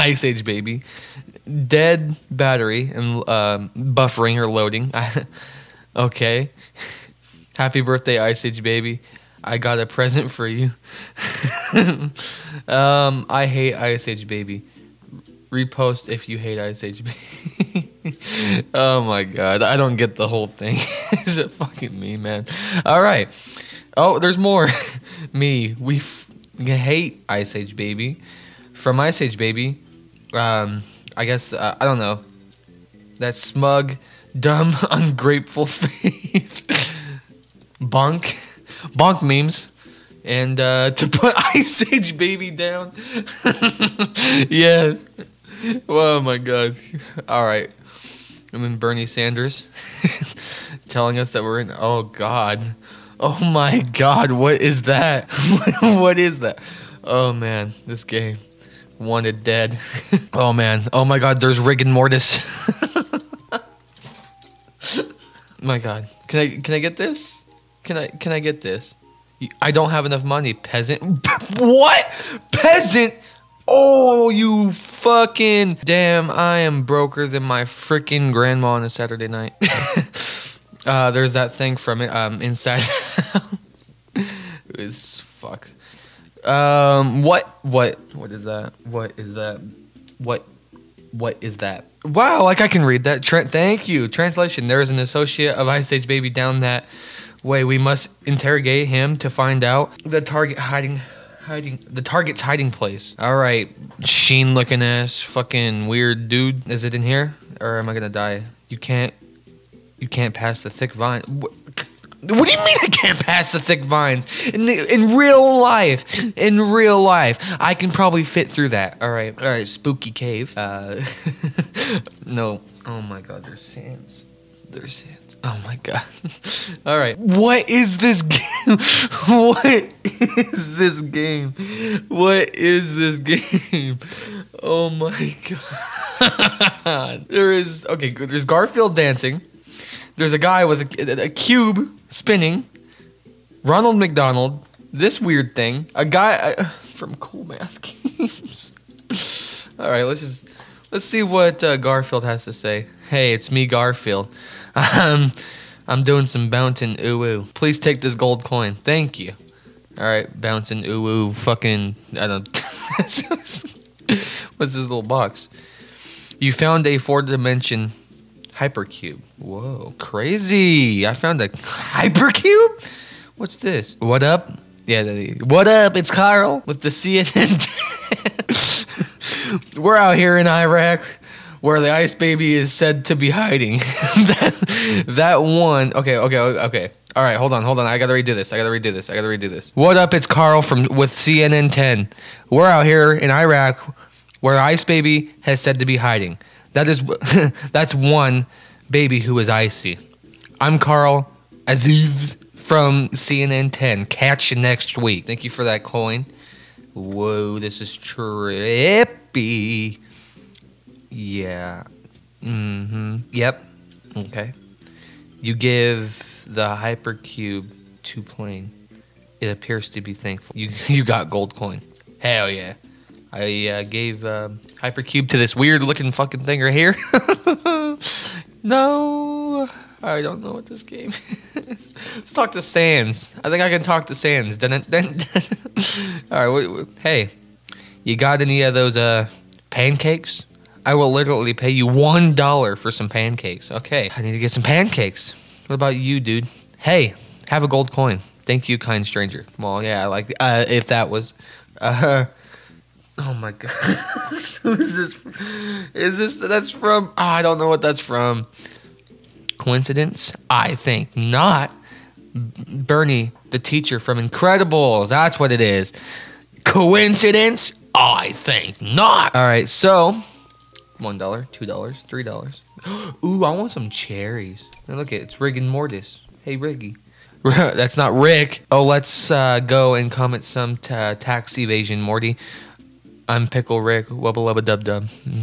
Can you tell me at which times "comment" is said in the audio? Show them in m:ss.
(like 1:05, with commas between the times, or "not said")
4:40.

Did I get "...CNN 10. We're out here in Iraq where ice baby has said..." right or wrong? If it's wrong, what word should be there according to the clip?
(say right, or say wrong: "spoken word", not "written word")
right.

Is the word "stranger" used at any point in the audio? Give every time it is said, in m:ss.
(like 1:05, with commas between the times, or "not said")
4:09.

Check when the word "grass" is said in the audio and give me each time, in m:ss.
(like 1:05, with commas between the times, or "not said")
not said.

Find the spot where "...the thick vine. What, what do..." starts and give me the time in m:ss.
1:50.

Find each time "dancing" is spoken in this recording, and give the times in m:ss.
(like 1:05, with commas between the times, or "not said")
2:18.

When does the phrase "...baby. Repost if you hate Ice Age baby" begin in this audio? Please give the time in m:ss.
0:14.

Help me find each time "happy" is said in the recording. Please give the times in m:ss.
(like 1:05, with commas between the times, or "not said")
0:07, 3:29.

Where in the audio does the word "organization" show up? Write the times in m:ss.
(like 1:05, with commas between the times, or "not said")
not said.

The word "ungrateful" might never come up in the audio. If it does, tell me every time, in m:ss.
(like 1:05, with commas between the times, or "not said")
0:34.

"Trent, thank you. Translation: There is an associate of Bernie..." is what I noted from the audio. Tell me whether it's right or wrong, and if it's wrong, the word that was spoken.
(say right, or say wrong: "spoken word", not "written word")
wrong: "Ice", not "Bernie".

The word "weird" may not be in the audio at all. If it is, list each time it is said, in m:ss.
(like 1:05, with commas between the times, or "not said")
1:45, 2:25, 3:45.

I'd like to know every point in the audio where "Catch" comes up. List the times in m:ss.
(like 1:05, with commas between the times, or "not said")
3:24.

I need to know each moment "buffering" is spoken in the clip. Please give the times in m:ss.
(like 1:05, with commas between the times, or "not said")
0:03.